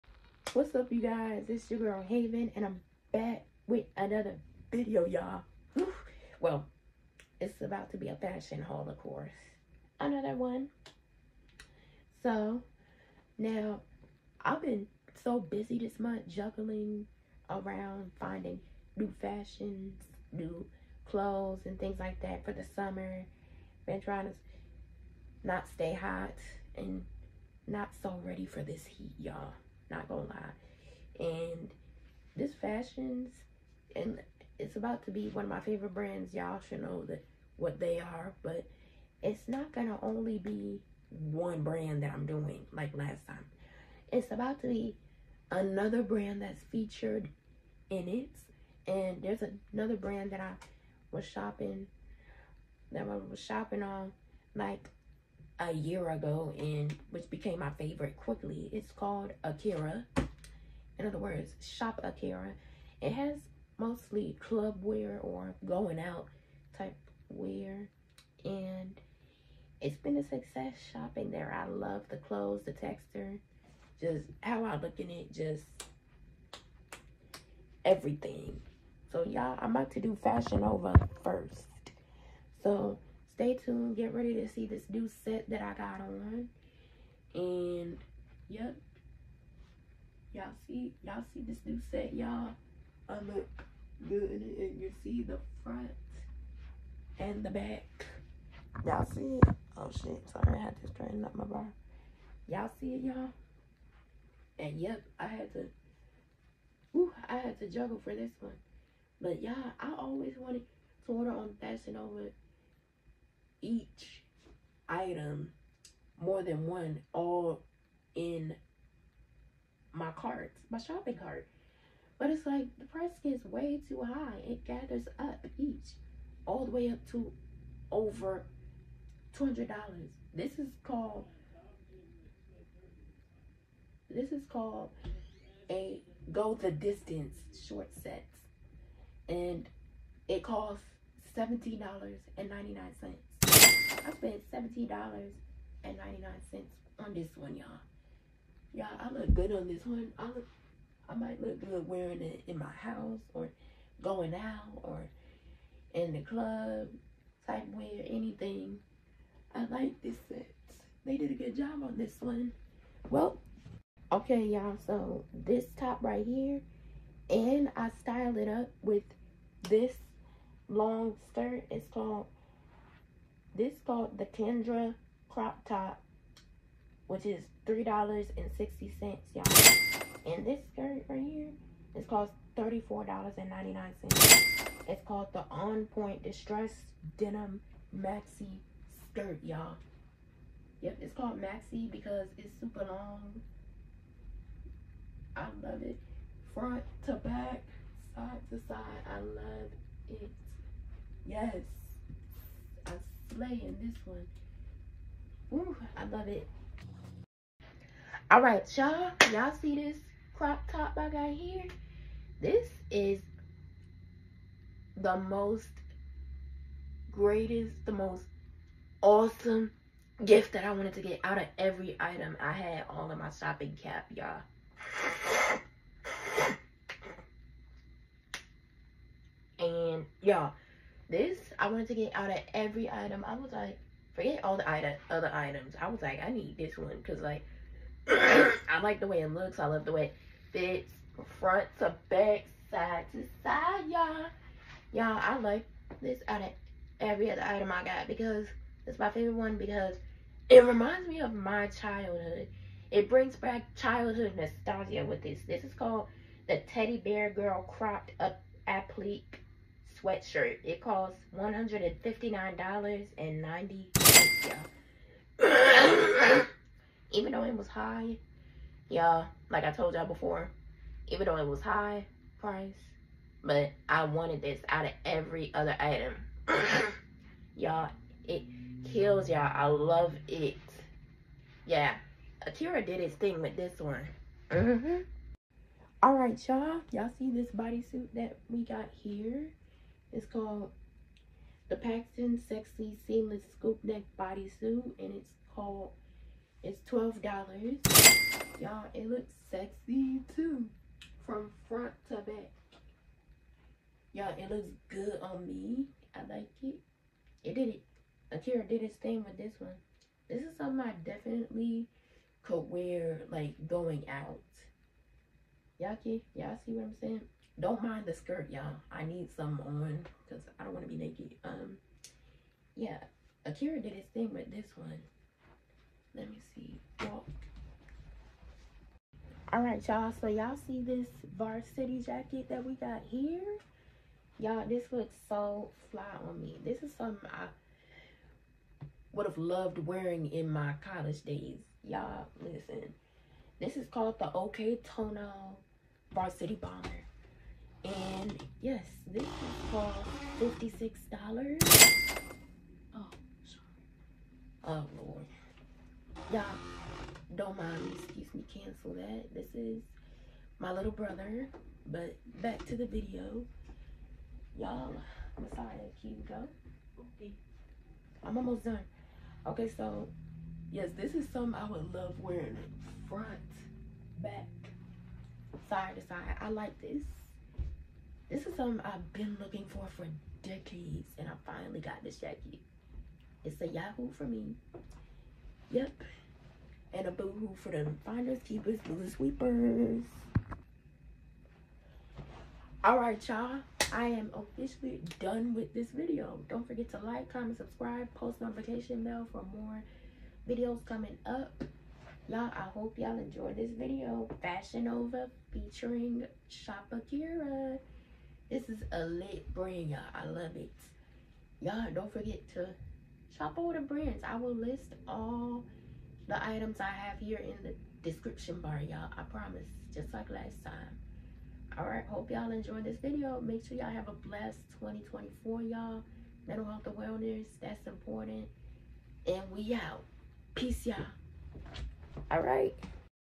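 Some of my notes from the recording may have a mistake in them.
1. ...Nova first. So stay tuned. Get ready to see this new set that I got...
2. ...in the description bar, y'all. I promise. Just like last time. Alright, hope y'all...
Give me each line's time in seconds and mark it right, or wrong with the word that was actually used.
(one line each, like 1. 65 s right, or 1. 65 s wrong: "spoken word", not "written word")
1. 80 s right
2. 417 s right.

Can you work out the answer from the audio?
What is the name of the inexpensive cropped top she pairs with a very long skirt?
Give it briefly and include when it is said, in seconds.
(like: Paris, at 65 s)
Kendra crop top, at 174 s.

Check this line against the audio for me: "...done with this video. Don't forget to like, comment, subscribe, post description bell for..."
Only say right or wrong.
wrong.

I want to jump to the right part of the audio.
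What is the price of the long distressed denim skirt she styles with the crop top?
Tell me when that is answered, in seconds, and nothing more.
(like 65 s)
182 s.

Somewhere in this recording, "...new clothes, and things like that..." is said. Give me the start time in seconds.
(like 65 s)
20 s.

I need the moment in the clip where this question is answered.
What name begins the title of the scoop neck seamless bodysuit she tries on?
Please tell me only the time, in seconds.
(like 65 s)
291 s.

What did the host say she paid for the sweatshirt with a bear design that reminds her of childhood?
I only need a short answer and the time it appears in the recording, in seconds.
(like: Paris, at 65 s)
$159.90, at 261 s.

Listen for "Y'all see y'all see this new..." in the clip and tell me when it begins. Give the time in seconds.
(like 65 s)
90 s.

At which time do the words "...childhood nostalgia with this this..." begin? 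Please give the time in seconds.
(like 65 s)
253 s.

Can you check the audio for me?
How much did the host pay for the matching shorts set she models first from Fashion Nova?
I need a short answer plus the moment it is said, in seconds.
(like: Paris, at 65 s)
$17.99, at 140 s.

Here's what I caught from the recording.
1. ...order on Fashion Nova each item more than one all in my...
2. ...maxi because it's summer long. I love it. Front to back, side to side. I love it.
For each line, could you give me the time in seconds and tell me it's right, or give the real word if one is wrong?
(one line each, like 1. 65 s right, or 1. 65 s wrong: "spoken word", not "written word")
1. 111 s right
2. 191 s wrong: "super", not "summer".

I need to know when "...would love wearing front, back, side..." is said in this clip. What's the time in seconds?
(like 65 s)
371 s.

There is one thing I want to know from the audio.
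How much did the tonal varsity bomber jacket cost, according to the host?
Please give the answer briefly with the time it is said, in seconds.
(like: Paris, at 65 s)
$56, at 350 s.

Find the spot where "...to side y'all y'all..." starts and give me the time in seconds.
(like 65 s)
243 s.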